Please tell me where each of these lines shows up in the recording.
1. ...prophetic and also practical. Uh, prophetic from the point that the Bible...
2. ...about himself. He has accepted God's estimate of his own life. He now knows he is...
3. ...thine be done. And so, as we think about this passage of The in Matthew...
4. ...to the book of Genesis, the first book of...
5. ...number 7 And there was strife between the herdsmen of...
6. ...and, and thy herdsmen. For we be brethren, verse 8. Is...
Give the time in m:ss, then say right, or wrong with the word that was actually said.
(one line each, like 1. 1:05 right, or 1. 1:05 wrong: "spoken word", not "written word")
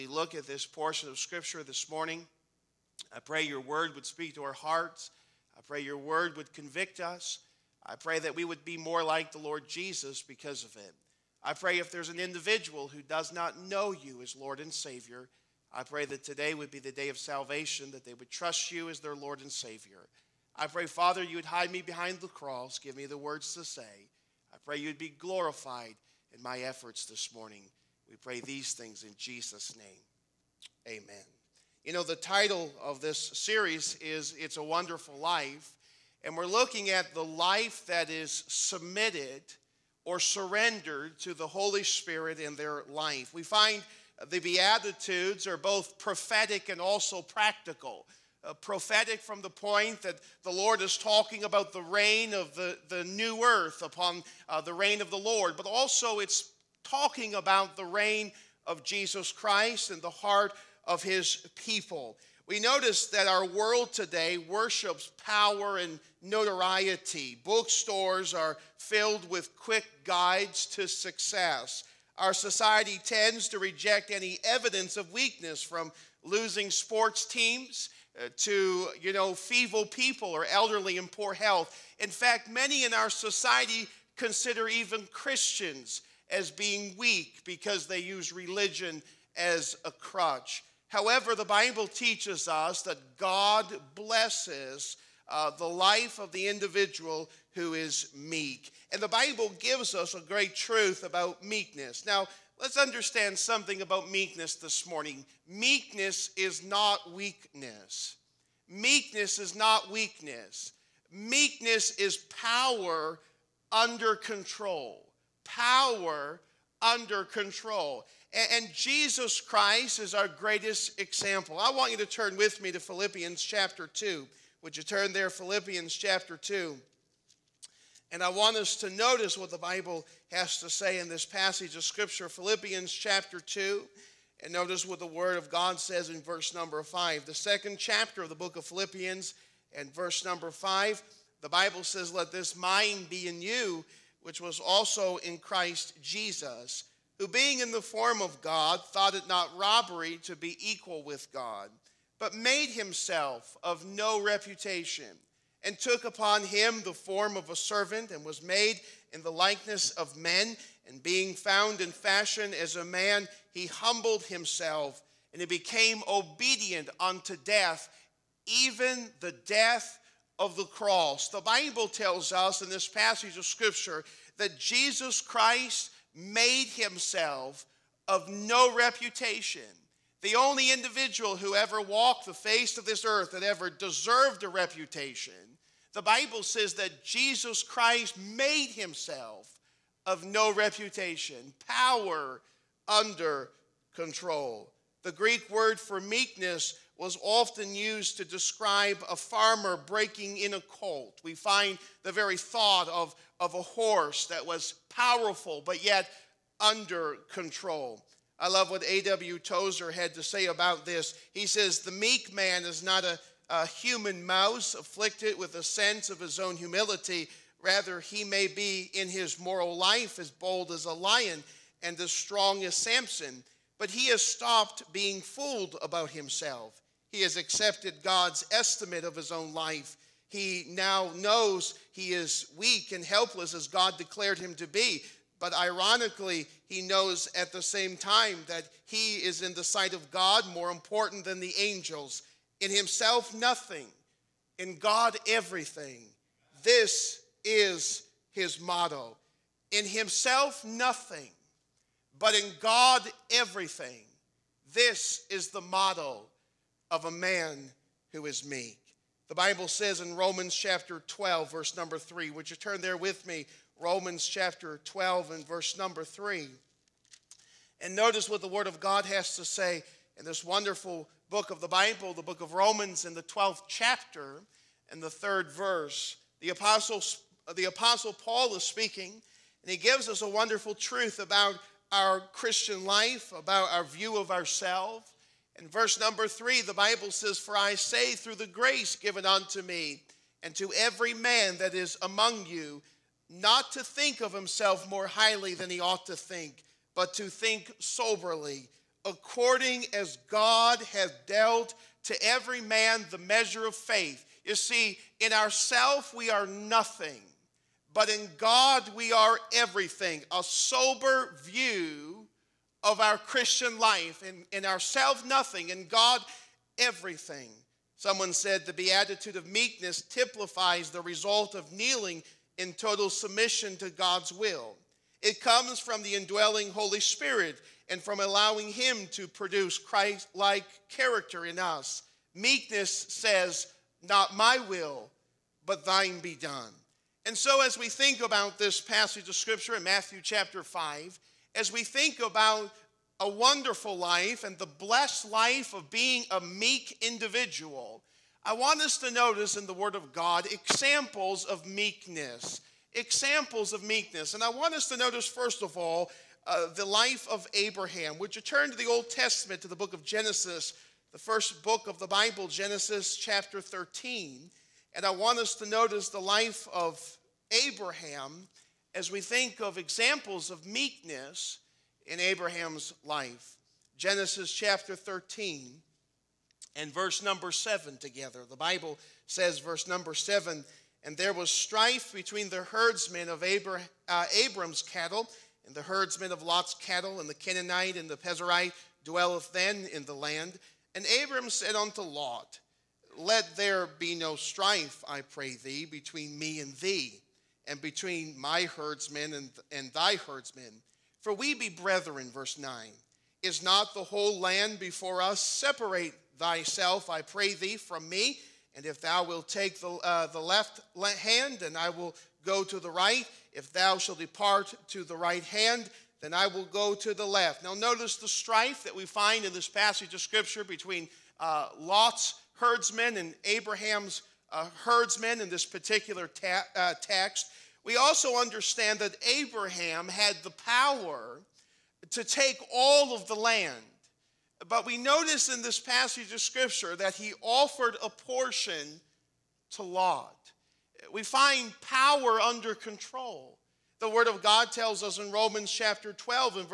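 1. 0:45 wrong: "Lord", not "Bible"
2. 3:45 right
3. 5:35 wrong: "Scripture", not "The"
4. 5:59 right
5. 6:19 right
6. 6:39 wrong: "9", not "8".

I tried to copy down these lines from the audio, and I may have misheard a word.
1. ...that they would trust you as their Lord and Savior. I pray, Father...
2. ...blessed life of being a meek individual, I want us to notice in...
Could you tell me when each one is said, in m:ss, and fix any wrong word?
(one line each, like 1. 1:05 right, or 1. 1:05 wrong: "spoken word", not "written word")
1. 0:17 right
2. 5:44 right.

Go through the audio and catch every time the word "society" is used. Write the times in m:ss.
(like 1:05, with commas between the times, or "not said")
1:12, 1:23.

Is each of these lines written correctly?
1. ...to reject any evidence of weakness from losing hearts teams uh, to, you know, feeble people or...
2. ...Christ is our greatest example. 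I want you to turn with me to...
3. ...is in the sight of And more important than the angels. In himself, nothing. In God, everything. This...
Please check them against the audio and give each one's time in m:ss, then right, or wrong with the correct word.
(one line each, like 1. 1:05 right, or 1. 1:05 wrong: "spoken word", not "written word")
1. 1:13 wrong: "sports", not "hearts"
2. 1:59 right
3. 3:59 wrong: "God", not "And".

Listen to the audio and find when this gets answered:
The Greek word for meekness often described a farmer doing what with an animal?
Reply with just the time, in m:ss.
3:19.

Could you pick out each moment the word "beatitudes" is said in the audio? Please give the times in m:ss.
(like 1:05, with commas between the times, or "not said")
0:44, 5:18.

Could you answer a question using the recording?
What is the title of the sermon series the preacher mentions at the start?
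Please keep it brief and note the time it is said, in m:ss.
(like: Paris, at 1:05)
It's a Wonderful Life, at 0:34.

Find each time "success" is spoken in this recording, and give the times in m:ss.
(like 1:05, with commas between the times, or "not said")
1:10.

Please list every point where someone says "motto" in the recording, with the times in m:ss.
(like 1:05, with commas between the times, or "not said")
4:08, 4:15.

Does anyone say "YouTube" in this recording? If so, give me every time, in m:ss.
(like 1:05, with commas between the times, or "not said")
not said.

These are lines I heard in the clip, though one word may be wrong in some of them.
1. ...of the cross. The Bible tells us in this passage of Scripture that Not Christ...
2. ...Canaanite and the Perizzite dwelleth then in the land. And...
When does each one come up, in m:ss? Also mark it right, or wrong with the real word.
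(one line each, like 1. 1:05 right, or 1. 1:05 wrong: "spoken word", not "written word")
1. 2:50 wrong: "Jesus", not "Not"
2. 6:27 right.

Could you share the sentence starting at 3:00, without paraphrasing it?
The only individual who ever walked the face of this earth that ever deserved a reputation.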